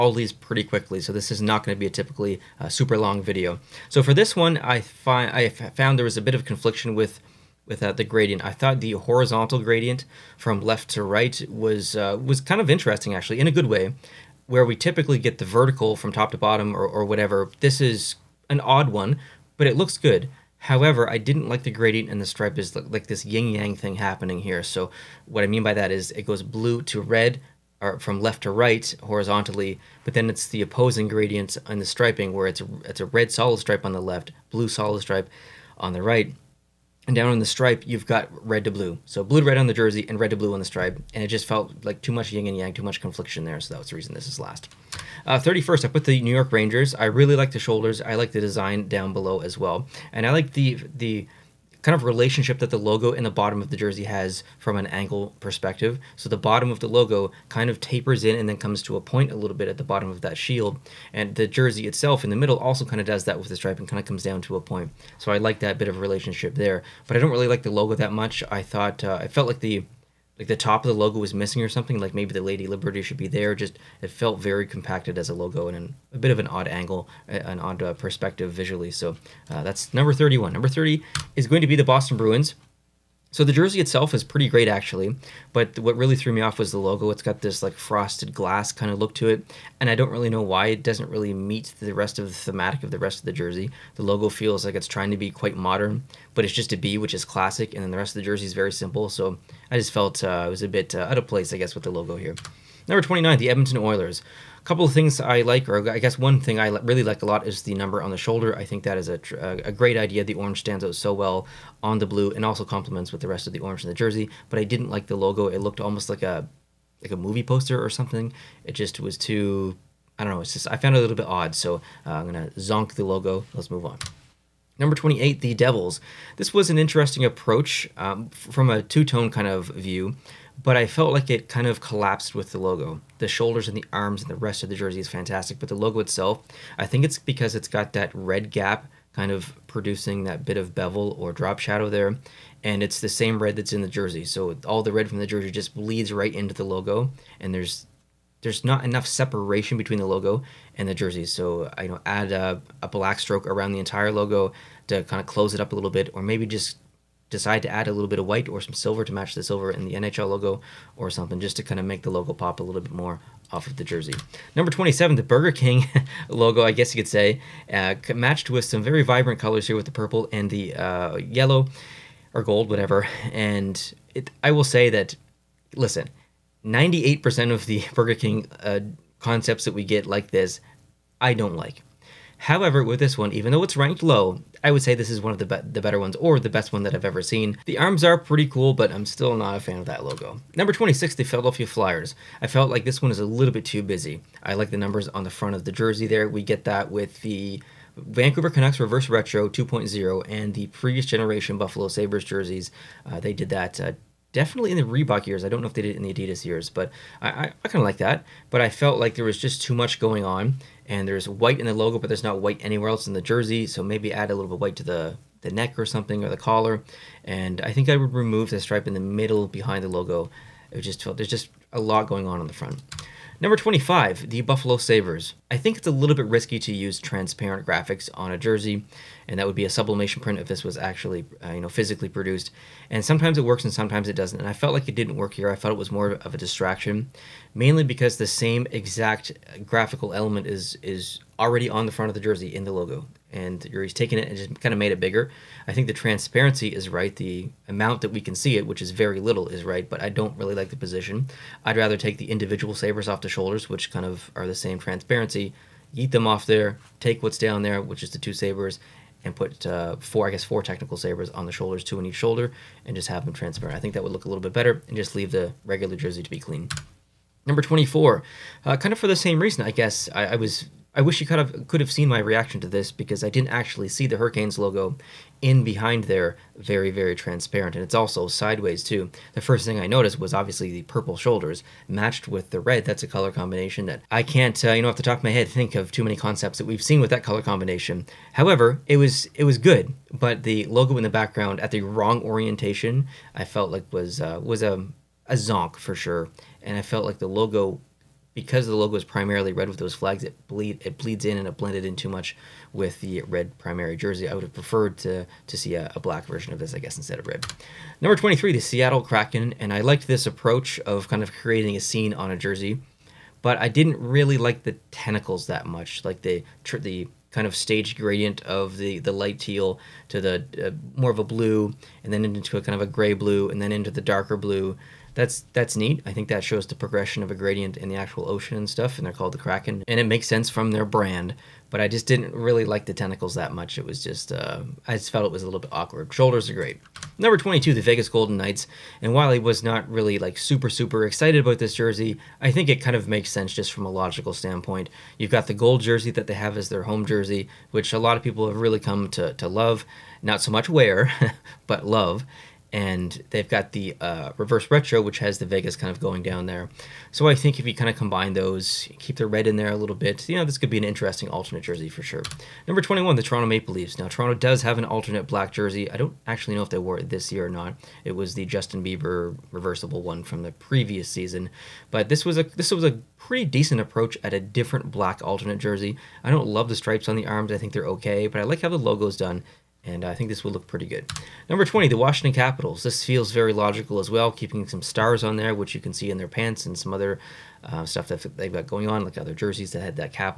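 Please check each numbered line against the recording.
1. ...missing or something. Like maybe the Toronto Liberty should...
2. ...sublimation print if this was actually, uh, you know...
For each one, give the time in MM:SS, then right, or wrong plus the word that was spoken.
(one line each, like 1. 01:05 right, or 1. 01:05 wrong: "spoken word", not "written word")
1. 01:11 wrong: "Lady", not "Toronto"
2. 03:49 right.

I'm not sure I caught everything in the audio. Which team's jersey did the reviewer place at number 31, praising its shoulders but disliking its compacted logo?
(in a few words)
New York Rangers.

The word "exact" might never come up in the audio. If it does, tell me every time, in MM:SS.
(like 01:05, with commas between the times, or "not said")
03:58.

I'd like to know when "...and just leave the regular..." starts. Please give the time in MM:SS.
04:24.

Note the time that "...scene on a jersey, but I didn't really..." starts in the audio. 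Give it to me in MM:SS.
05:11.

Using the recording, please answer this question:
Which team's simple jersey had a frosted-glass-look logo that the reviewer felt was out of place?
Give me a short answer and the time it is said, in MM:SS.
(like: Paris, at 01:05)
Boston Bruins, at 01:21.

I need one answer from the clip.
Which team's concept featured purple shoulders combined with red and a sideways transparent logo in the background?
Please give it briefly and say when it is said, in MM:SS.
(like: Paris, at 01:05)
Hurricanes, at 04:34.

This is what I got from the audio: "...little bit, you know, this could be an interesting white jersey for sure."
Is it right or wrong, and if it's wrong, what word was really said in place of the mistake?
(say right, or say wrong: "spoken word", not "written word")
wrong: "alternate", not "white".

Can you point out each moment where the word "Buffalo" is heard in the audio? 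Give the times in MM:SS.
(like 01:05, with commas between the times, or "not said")
03:21, 03:44.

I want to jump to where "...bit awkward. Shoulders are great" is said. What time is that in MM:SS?
05:35.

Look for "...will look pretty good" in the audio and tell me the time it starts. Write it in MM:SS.
06:20.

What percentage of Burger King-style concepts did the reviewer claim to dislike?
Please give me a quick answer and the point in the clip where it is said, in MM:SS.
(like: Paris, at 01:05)
98%, at 02:56.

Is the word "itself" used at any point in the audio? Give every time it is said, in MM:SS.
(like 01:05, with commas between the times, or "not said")
01:01, 01:23, 02:15.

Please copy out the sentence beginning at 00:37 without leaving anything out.
And down on the stripe, you've got red to blue.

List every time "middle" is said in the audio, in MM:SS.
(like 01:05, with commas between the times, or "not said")
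01:02, 03:39.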